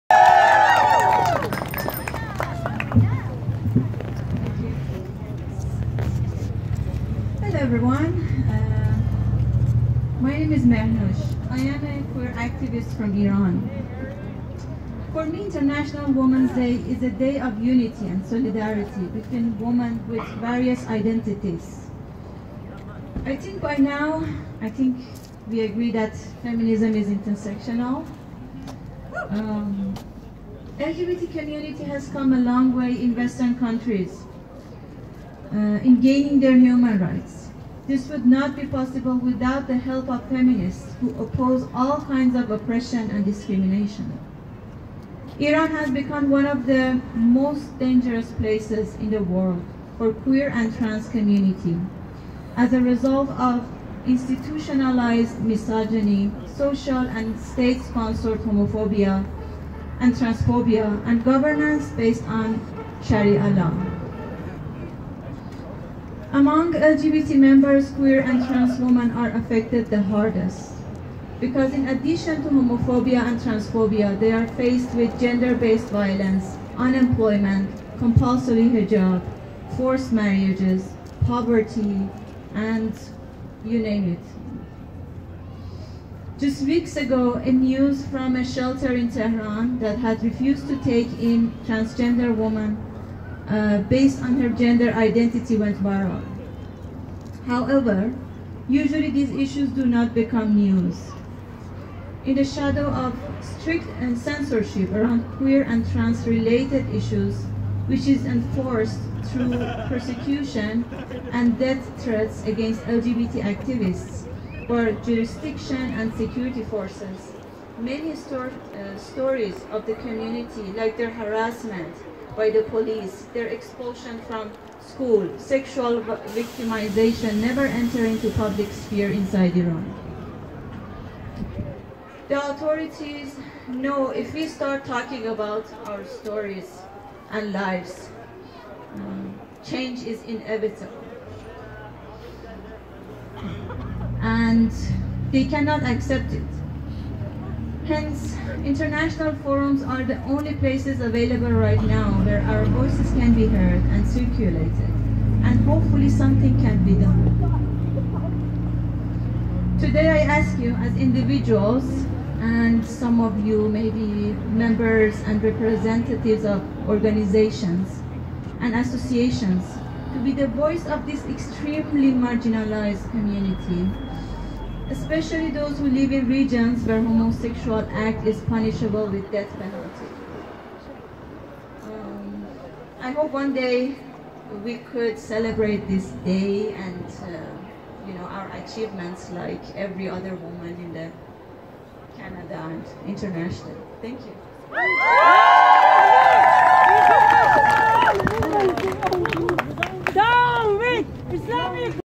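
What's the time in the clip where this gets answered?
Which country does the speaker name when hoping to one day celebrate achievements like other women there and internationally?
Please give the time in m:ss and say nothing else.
3:12.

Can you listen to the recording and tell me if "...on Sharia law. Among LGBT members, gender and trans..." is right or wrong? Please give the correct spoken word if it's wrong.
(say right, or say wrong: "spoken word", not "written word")
wrong: "queer", not "gender".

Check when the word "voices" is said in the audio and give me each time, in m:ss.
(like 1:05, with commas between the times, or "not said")
2:32, 2:50.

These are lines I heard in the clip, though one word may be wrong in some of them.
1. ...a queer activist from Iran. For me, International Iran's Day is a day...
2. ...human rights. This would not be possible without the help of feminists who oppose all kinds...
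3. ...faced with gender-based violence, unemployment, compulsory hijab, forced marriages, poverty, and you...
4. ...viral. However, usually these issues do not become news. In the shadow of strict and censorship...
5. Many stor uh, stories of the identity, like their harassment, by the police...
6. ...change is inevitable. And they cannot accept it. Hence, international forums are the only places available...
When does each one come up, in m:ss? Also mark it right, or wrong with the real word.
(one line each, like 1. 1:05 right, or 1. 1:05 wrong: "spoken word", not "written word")
1. 0:11 wrong: "Women", not "Iran"
2. 0:36 right
3. 1:14 right
4. 1:35 right
5. 1:57 wrong: "community", not "identity"
6. 2:19 right.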